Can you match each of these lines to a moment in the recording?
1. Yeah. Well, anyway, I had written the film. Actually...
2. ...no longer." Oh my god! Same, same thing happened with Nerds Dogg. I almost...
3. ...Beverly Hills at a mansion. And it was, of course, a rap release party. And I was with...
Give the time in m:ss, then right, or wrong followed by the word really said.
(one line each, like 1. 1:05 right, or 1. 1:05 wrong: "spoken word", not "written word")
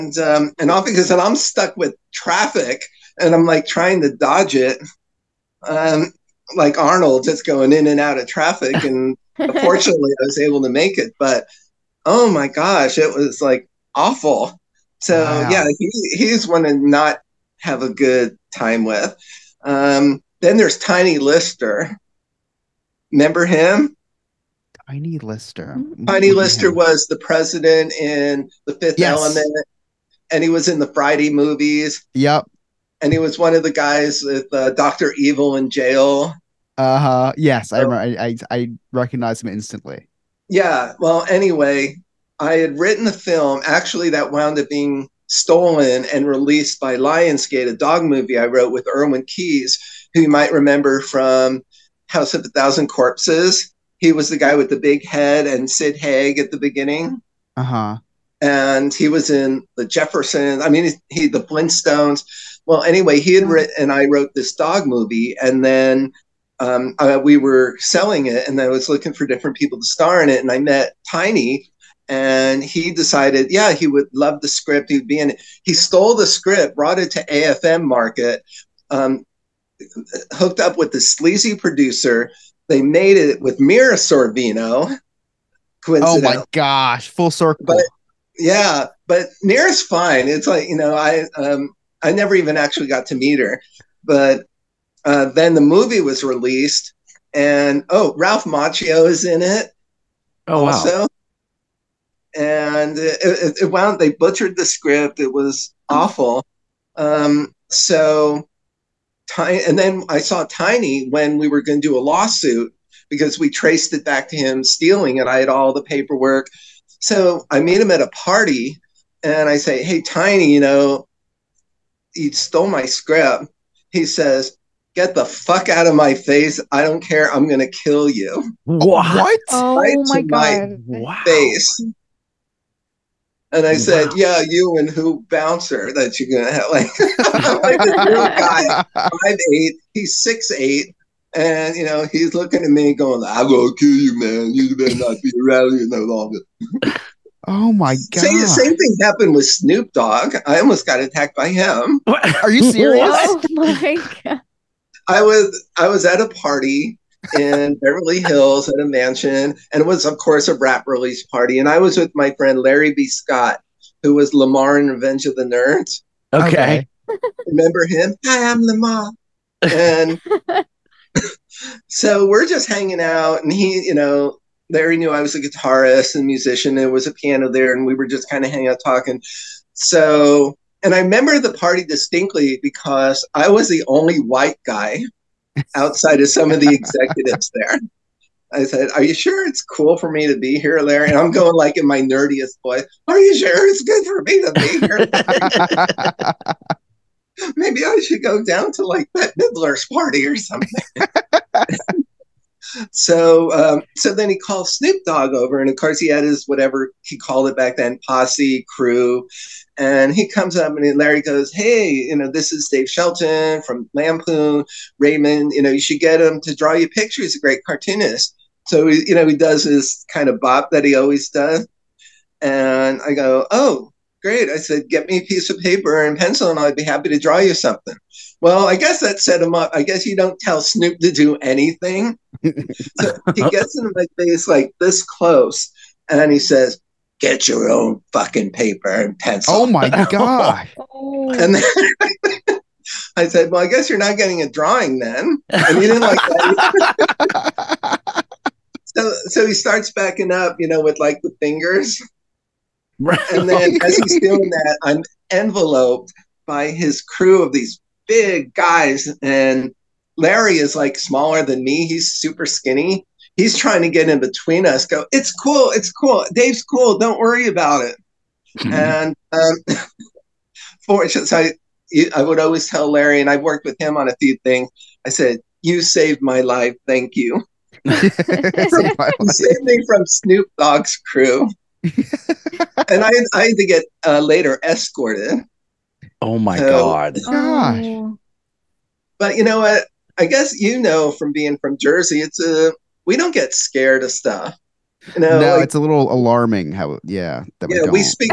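1. 0:40 right
2. 2:25 wrong: "Snoop", not "Nerds"
3. 2:37 right.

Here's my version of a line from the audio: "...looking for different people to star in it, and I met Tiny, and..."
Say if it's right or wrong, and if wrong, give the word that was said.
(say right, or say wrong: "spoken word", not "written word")
right.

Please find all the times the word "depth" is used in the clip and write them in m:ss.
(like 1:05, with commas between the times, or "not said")
not said.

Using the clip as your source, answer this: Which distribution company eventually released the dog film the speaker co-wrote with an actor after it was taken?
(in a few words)
Lionsgate.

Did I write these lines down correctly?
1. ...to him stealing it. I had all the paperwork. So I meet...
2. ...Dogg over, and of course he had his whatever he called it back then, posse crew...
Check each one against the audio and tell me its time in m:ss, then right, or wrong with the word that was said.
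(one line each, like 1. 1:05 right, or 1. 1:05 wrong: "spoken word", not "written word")
1. 1:54 right
2. 3:25 right.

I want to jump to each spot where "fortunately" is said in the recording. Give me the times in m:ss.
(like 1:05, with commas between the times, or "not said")
0:09, 4:30.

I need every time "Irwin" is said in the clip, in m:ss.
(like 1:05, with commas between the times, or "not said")
0:48.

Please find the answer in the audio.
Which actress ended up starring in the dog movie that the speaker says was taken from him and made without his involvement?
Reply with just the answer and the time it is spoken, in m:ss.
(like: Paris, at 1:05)
Mira Sorvino, at 1:23.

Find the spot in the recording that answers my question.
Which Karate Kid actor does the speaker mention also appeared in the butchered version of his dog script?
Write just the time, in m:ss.
1:38.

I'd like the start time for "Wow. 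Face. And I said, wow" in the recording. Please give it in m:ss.
2:10.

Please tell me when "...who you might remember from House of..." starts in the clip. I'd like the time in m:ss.
0:50.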